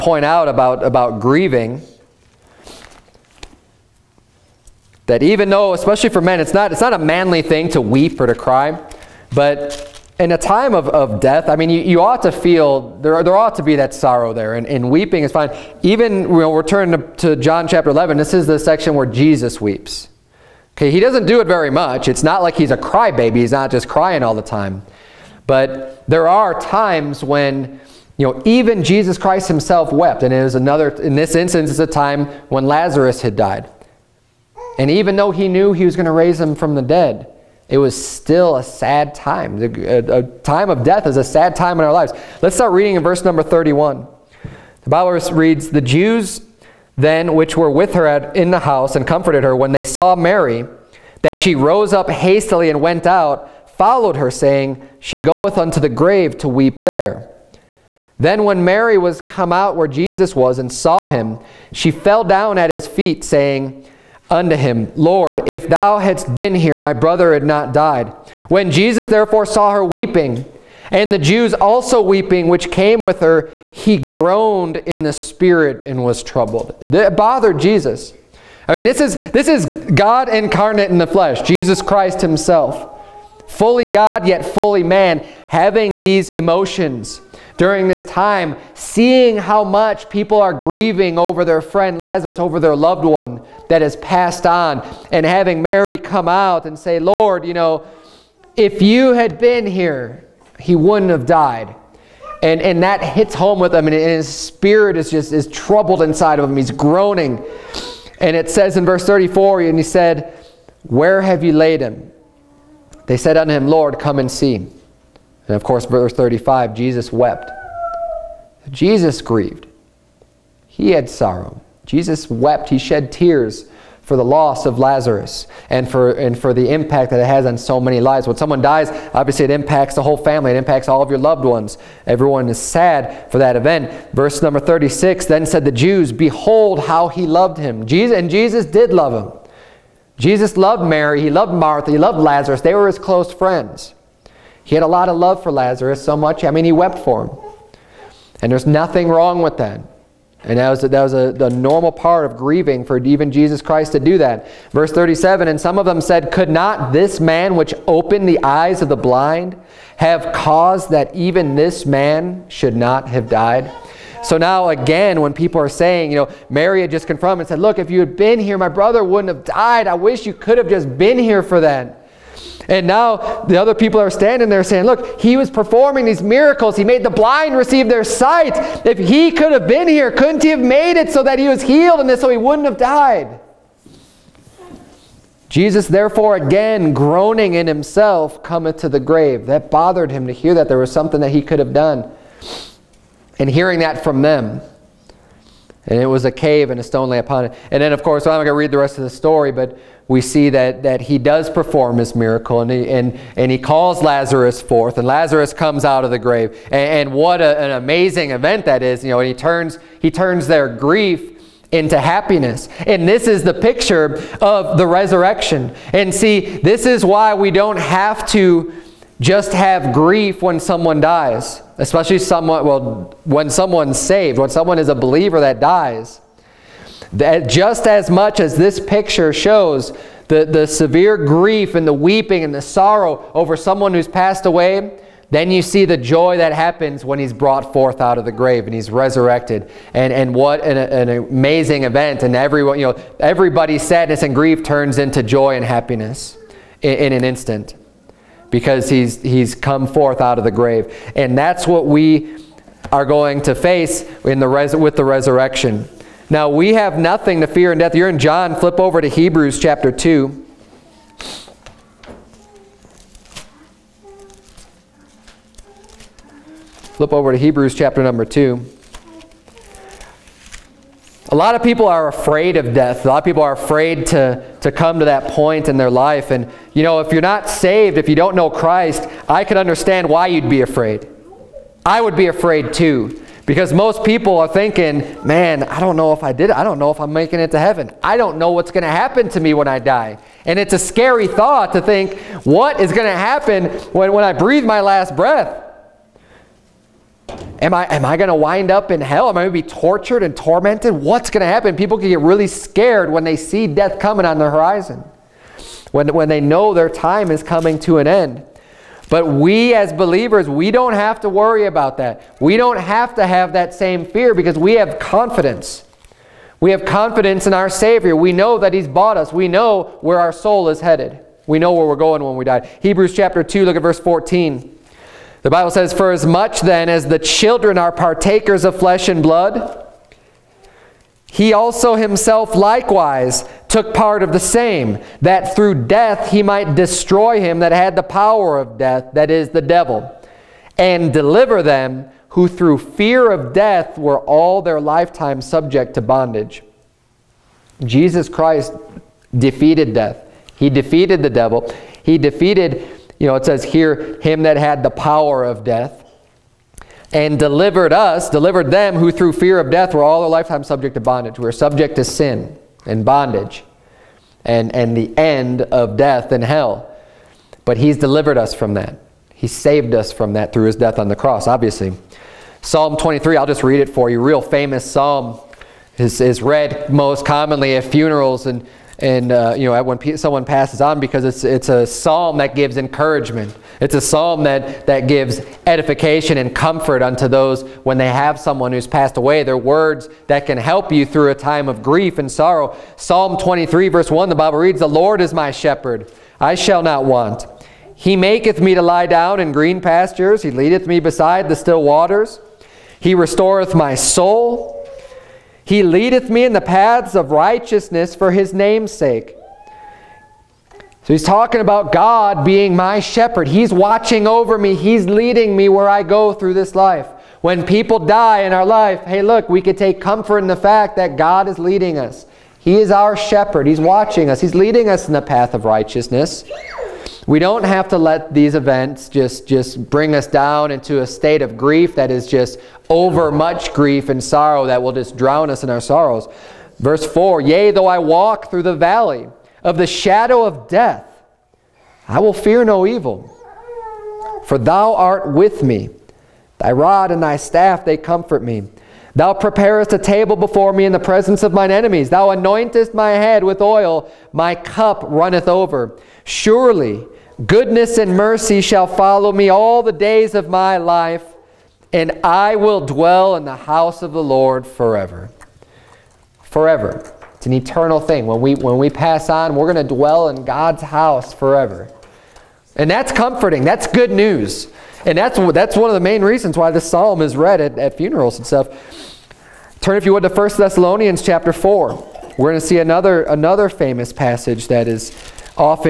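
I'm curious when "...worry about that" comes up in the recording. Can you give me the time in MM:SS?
05:11.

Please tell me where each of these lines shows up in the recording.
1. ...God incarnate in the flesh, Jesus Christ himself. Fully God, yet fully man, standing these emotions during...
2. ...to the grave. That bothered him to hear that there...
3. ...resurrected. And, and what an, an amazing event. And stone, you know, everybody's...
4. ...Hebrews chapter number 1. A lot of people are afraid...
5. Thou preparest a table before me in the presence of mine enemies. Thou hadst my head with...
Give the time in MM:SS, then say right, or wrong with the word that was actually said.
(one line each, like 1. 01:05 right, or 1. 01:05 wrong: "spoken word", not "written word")
1. 01:19 wrong: "having", not "standing"
2. 03:08 right
3. 03:58 wrong: "everyone", not "stone"
4. 04:27 wrong: "2", not "1"
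5. 07:29 wrong: "anointest", not "hadst".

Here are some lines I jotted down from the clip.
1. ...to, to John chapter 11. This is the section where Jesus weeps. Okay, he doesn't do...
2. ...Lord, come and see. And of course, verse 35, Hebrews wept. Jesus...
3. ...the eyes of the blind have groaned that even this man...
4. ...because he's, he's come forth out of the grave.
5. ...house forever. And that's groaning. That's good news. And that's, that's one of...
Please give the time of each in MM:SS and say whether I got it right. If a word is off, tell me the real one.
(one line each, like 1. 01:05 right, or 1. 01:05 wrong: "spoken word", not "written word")
1. 00:16 right
2. 01:53 wrong: "Jesus", not "Hebrews"
3. 02:38 wrong: "caused", not "groaned"
4. 04:08 right
5. 07:50 wrong: "comforting", not "groaning".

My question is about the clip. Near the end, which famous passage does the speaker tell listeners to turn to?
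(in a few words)
1 Thessalonians 4.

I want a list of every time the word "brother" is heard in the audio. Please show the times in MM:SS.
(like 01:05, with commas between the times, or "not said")
01:06, 02:48.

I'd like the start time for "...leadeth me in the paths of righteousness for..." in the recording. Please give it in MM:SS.
06:45.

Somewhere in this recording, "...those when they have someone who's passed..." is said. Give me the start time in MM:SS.
06:27.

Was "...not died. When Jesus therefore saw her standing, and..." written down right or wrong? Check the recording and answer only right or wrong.
wrong.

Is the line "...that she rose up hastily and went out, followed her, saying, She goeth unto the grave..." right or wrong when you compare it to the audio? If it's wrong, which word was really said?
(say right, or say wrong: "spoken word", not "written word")
right.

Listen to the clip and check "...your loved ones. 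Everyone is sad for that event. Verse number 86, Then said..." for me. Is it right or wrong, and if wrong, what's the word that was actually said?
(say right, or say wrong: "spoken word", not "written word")
wrong: "36", not "86".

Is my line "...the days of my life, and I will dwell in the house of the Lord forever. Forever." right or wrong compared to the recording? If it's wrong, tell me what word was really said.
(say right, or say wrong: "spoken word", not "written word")
right.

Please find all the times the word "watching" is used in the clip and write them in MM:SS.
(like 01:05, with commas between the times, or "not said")
06:53, 07:03.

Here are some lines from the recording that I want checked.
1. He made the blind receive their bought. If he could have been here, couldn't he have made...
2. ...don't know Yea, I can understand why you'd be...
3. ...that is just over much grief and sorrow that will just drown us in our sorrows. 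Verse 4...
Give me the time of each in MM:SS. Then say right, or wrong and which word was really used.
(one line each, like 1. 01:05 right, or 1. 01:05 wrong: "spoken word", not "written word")
1. 02:56 wrong: "sight", not "bought"
2. 04:38 wrong: "Christ", not "Yea"
3. 07:11 right.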